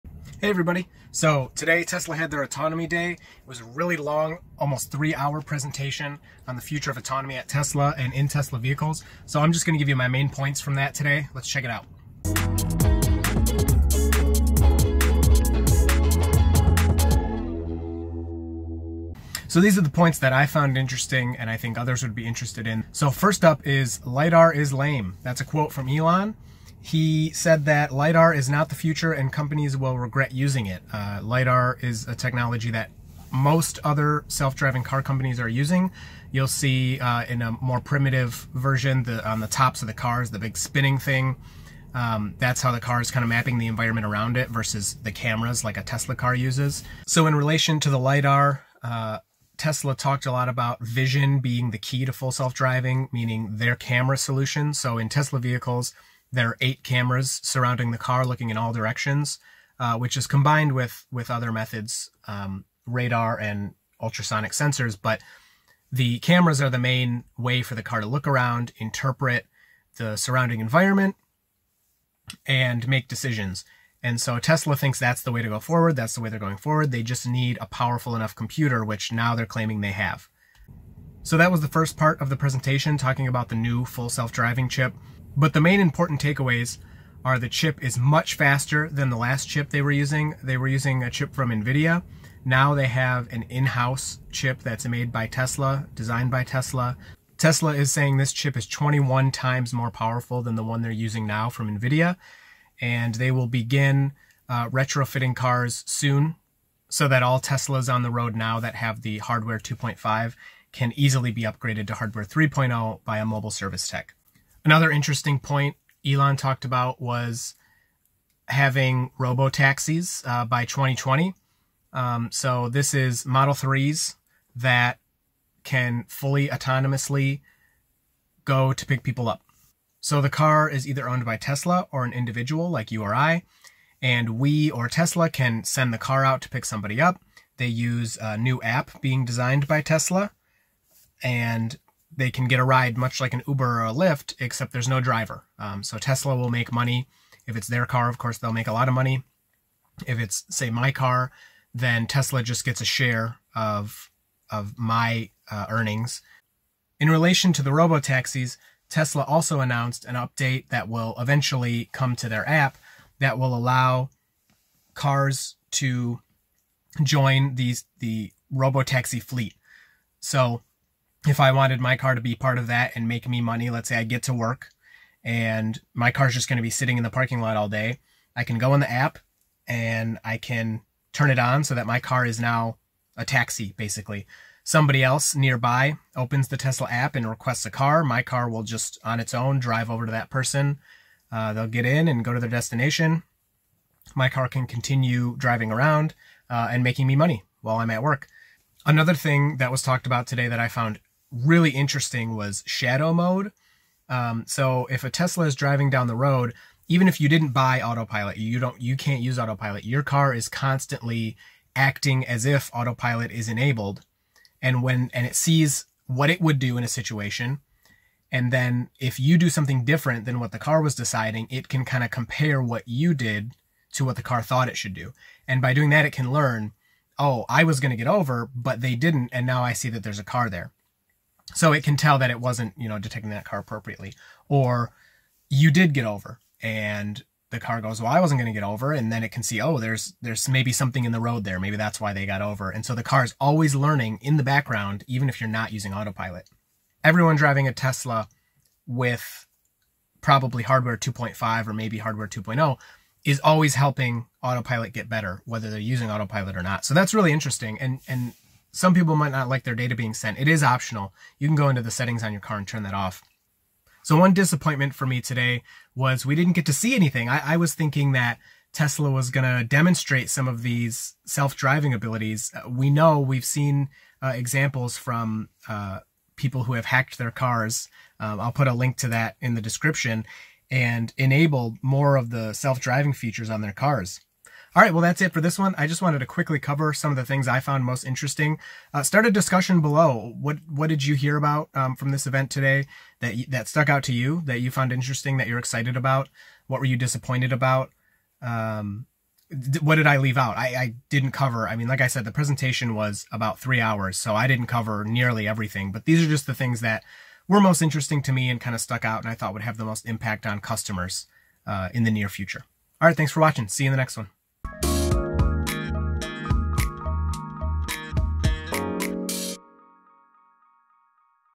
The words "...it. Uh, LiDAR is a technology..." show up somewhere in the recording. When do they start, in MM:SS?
00:30.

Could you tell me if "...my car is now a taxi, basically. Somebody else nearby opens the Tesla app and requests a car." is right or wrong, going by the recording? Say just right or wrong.
right.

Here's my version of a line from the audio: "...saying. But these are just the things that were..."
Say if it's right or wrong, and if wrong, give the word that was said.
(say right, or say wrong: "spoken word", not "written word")
wrong: "everything", not "saying".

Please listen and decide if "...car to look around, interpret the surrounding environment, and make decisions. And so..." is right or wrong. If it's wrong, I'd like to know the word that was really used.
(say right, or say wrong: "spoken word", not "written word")
right.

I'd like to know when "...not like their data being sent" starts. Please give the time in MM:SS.
04:19.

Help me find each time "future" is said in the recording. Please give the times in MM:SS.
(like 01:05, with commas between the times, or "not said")
00:06, 00:28, 05:12.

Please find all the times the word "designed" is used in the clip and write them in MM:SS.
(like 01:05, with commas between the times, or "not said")
01:35, 02:19.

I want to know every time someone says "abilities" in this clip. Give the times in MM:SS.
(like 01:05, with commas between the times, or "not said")
04:31.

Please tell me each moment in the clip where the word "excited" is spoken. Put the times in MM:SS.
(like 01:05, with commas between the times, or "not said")
04:55.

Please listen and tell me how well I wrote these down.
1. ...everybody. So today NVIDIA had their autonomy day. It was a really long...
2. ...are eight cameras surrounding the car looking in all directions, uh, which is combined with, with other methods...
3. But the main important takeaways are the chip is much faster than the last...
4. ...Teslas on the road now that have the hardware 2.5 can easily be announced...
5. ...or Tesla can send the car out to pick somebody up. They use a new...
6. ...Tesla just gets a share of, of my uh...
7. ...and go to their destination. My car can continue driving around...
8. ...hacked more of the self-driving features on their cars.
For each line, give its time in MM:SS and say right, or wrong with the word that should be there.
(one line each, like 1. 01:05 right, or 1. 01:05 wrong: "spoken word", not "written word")
1. 00:00 wrong: "Tesla", not "NVIDIA"
2. 00:56 right
3. 01:25 right
4. 01:47 wrong: "upgraded", not "announced"
5. 02:14 right
6. 02:32 right
7. 03:12 right
8. 04:41 wrong: "enabled", not "hacked".